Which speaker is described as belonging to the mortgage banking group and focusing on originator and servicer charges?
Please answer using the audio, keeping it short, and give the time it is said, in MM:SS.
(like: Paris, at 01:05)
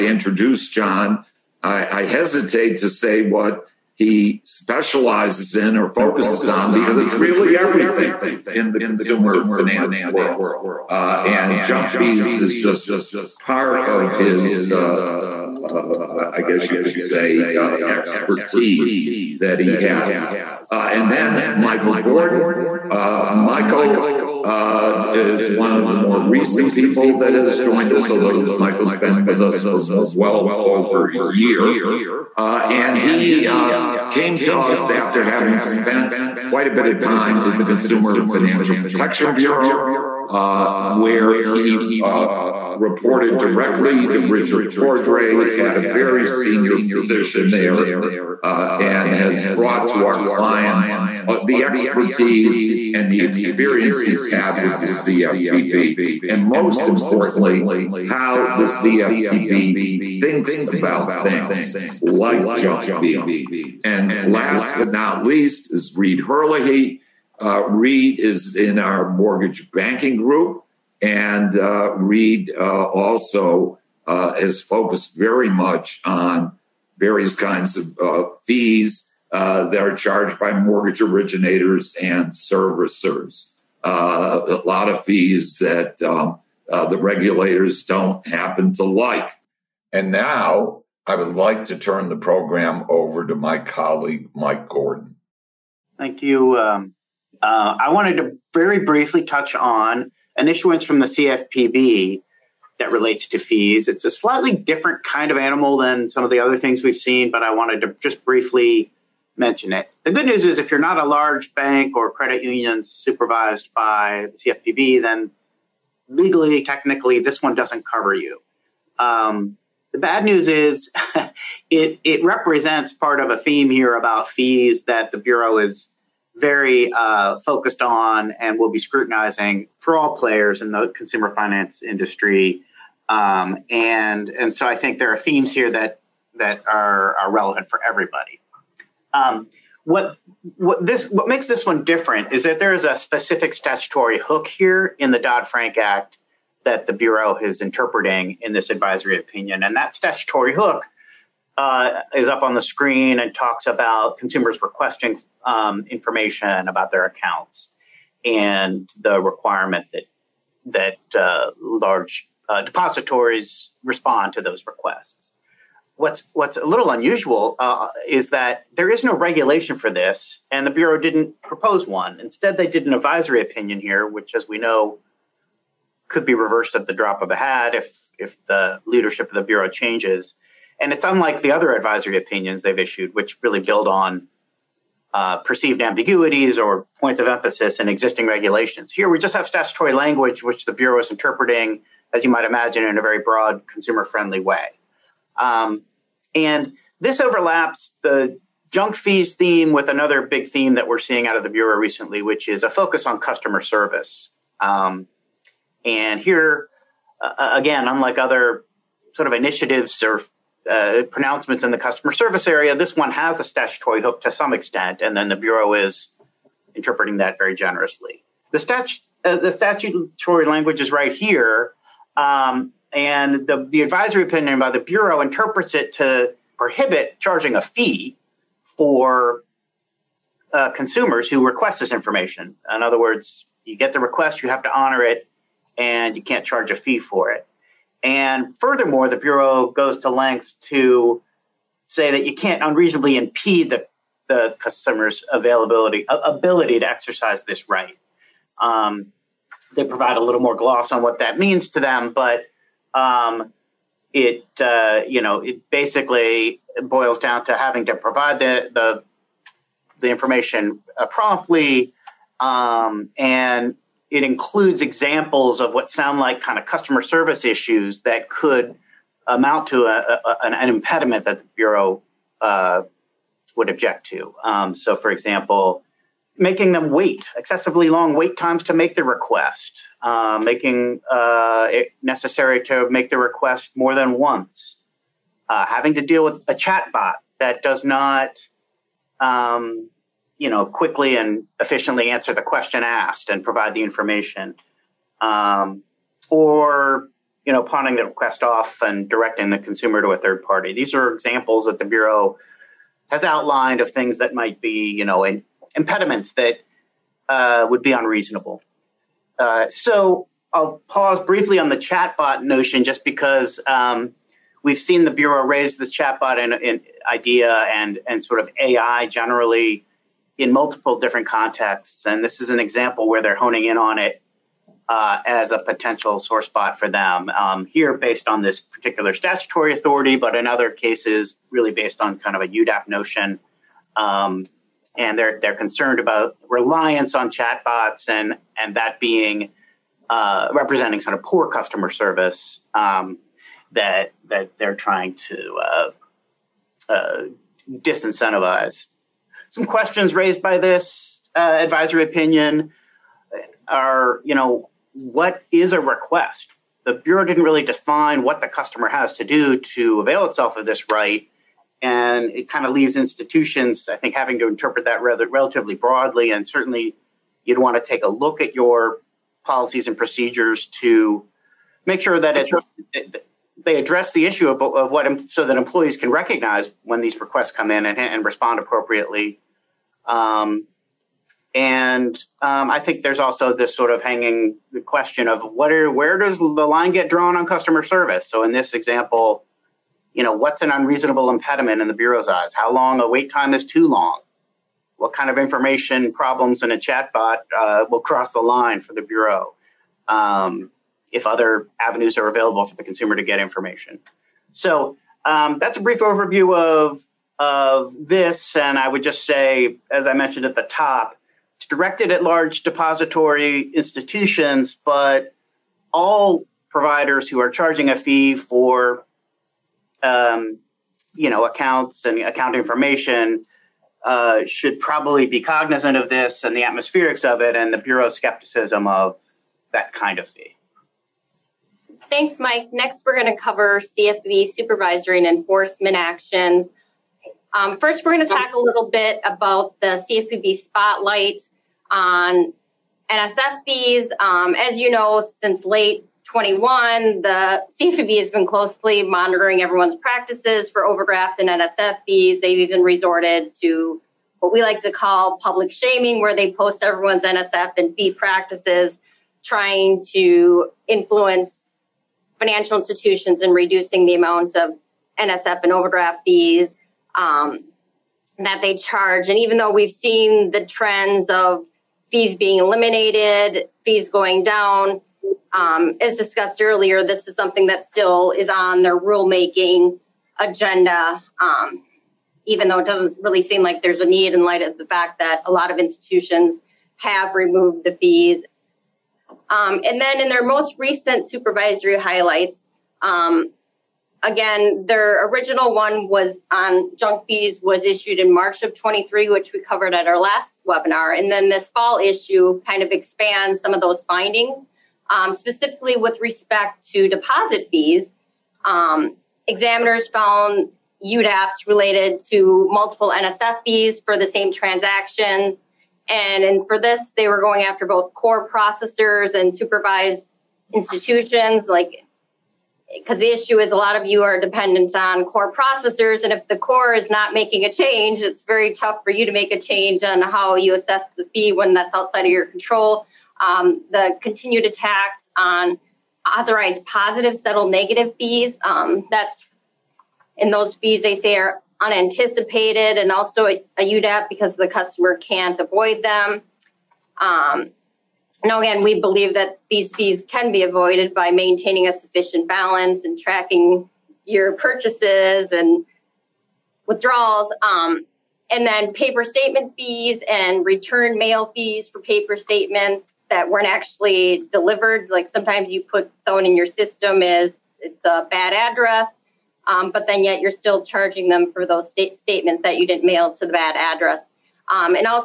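Reed Herlihy, at 01:05.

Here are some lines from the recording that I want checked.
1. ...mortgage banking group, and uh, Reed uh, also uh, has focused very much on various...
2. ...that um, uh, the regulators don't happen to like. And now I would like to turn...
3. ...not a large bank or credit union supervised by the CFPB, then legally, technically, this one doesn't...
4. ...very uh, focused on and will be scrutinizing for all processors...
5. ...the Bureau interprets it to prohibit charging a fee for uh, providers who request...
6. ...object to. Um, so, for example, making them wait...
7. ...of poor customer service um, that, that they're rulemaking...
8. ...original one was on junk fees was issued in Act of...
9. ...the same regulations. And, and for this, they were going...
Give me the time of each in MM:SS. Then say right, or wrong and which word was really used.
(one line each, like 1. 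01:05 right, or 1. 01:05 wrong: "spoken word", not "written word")
1. 01:09 right
2. 01:25 right
3. 01:50 right
4. 02:06 wrong: "players", not "processors"
5. 03:44 wrong: "consumers", not "providers"
6. 04:33 right
7. 05:41 wrong: "trying", not "rulemaking"
8. 08:15 wrong: "March", not "Act"
9. 08:34 wrong: "transactions", not "regulations".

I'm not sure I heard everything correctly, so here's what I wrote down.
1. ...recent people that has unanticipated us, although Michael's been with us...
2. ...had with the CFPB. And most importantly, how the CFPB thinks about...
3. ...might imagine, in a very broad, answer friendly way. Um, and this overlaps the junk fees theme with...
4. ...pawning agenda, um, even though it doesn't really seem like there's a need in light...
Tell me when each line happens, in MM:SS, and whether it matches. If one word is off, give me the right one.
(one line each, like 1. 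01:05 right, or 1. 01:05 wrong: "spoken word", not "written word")
1. 00:26 wrong: "joined", not "unanticipated"
2. 00:54 right
3. 03:12 wrong: "consumer", not "answer"
4. 07:58 wrong: "rulemaking", not "pawning".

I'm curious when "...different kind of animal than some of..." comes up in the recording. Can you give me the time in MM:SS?
01:44.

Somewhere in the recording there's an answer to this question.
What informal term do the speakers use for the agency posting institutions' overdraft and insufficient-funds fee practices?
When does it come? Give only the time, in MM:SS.
07:35.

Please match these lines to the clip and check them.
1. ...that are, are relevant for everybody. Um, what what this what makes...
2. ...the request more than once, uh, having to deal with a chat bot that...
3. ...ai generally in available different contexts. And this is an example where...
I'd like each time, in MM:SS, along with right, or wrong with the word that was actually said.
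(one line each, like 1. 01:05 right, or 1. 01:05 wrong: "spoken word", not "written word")
1. 02:16 right
2. 04:43 right
3. 05:18 wrong: "multiple", not "available".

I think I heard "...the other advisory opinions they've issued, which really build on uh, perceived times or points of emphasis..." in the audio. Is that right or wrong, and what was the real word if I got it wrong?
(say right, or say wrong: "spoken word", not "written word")
wrong: "ambiguities", not "times".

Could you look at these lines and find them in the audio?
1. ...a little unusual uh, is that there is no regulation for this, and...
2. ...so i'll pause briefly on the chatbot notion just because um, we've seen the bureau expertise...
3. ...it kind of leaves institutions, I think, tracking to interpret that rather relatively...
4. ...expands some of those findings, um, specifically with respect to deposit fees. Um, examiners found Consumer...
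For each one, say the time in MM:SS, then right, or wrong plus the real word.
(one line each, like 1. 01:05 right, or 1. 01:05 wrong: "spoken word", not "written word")
1. 02:46 right
2. 05:09 wrong: "raise", not "expertise"
3. 06:02 wrong: "having", not "tracking"
4. 08:22 wrong: "UDAPs", not "Consumer".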